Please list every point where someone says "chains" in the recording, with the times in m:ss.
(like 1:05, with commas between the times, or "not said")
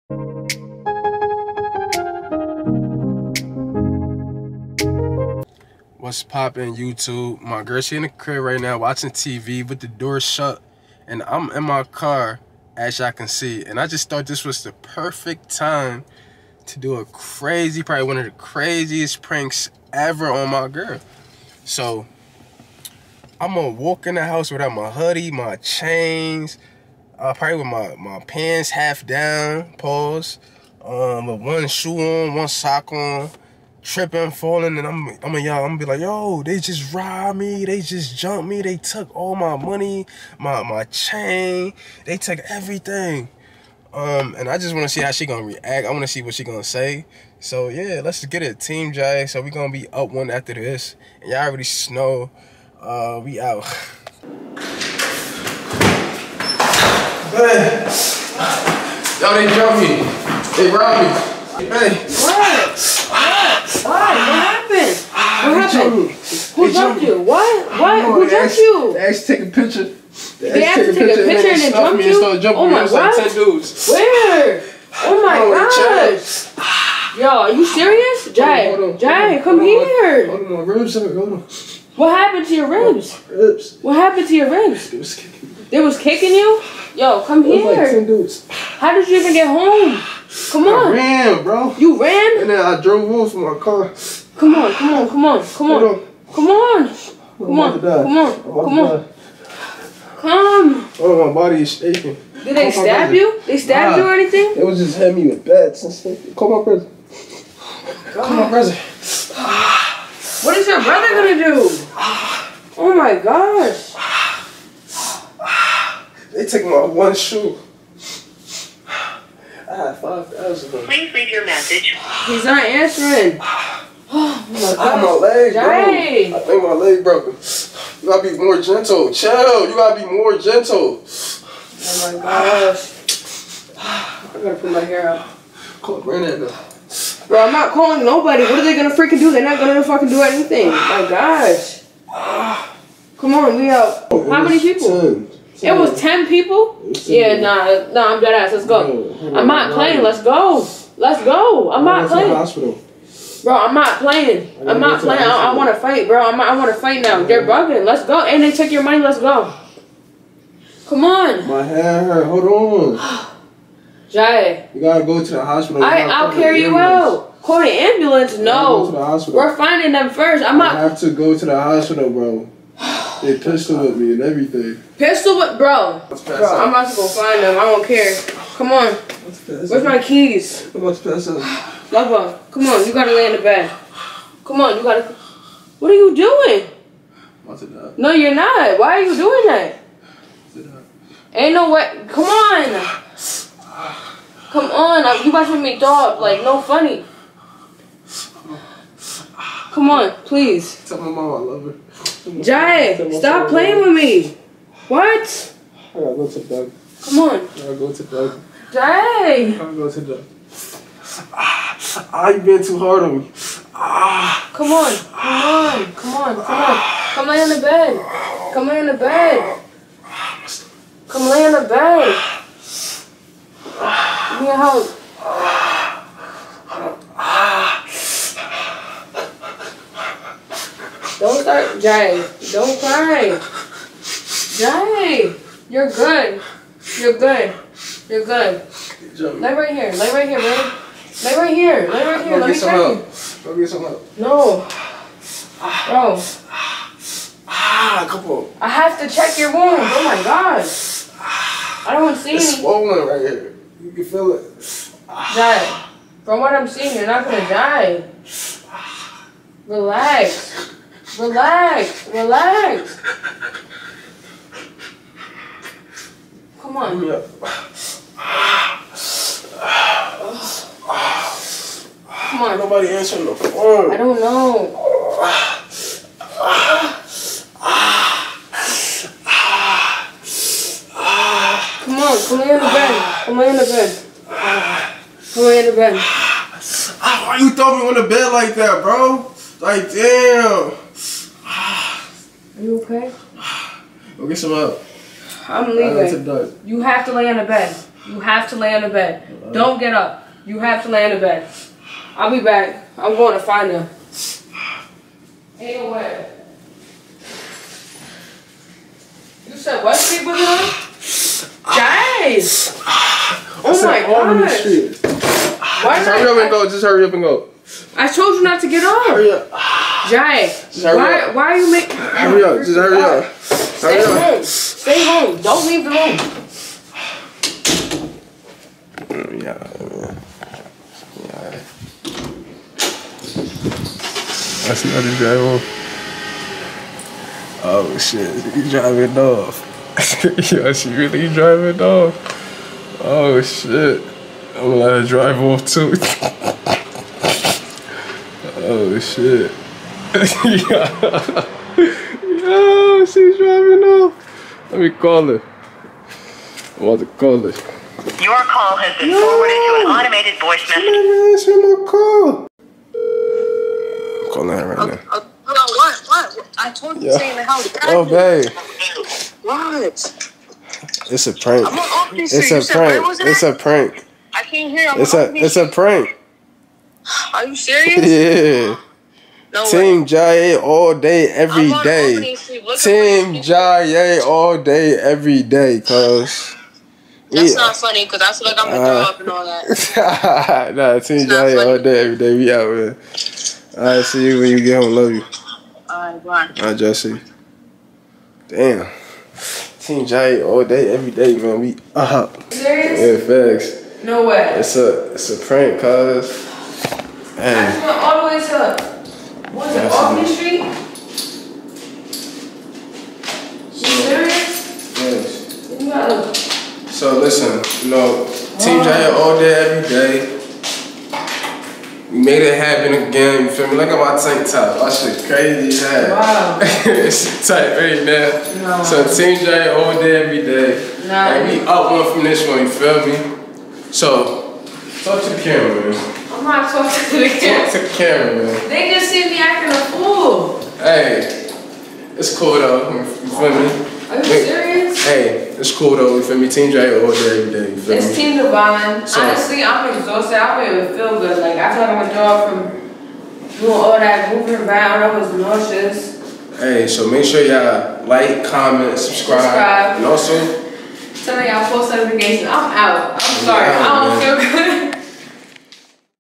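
0:25, 0:40.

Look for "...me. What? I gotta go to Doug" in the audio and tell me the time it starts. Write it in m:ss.
3:23.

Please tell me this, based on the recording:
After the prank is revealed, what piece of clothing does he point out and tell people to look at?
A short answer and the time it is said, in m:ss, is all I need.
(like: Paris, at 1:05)
tank top, at 7:04.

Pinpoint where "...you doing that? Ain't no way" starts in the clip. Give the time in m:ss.
3:09.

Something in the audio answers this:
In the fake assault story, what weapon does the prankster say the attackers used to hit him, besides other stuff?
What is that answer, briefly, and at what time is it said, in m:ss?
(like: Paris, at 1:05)
bats, at 1:45.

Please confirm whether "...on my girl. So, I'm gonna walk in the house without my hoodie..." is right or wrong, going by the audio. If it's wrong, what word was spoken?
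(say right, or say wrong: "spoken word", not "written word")
right.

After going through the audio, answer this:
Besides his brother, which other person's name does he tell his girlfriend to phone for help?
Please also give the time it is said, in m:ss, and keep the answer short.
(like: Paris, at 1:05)
Brandon, at 2:16.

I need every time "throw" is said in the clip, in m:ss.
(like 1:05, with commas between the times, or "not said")
4:47, 6:29.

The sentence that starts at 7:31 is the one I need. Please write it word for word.
Like I told my dog from doing all that moving around, I was nauseous.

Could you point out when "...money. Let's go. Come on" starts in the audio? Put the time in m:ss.
2:38.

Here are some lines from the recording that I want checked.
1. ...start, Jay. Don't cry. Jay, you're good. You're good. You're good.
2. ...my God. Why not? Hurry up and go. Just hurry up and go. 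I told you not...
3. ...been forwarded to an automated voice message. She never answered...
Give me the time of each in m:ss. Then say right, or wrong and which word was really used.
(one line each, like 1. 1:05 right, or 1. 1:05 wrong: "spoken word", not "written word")
1. 3:51 right
2. 5:13 right
3. 5:58 right.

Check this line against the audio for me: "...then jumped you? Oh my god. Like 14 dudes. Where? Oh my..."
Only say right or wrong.
wrong.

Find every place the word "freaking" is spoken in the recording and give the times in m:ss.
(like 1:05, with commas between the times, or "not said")
2:18.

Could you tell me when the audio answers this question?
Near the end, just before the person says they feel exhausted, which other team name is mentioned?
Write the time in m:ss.
7:28.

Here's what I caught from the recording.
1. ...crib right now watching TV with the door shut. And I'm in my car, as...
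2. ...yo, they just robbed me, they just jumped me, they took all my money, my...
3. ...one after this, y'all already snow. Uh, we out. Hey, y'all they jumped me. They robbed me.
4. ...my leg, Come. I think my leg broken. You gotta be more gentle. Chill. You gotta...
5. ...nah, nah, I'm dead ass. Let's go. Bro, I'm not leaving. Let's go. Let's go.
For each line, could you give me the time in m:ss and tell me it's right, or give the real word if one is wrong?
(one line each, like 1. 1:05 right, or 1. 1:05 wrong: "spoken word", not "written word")
1. 0:08 right
2. 0:35 right
3. 0:50 right
4. 2:05 wrong: "Jay", not "Come"
5. 2:27 wrong: "playing", not "leaving".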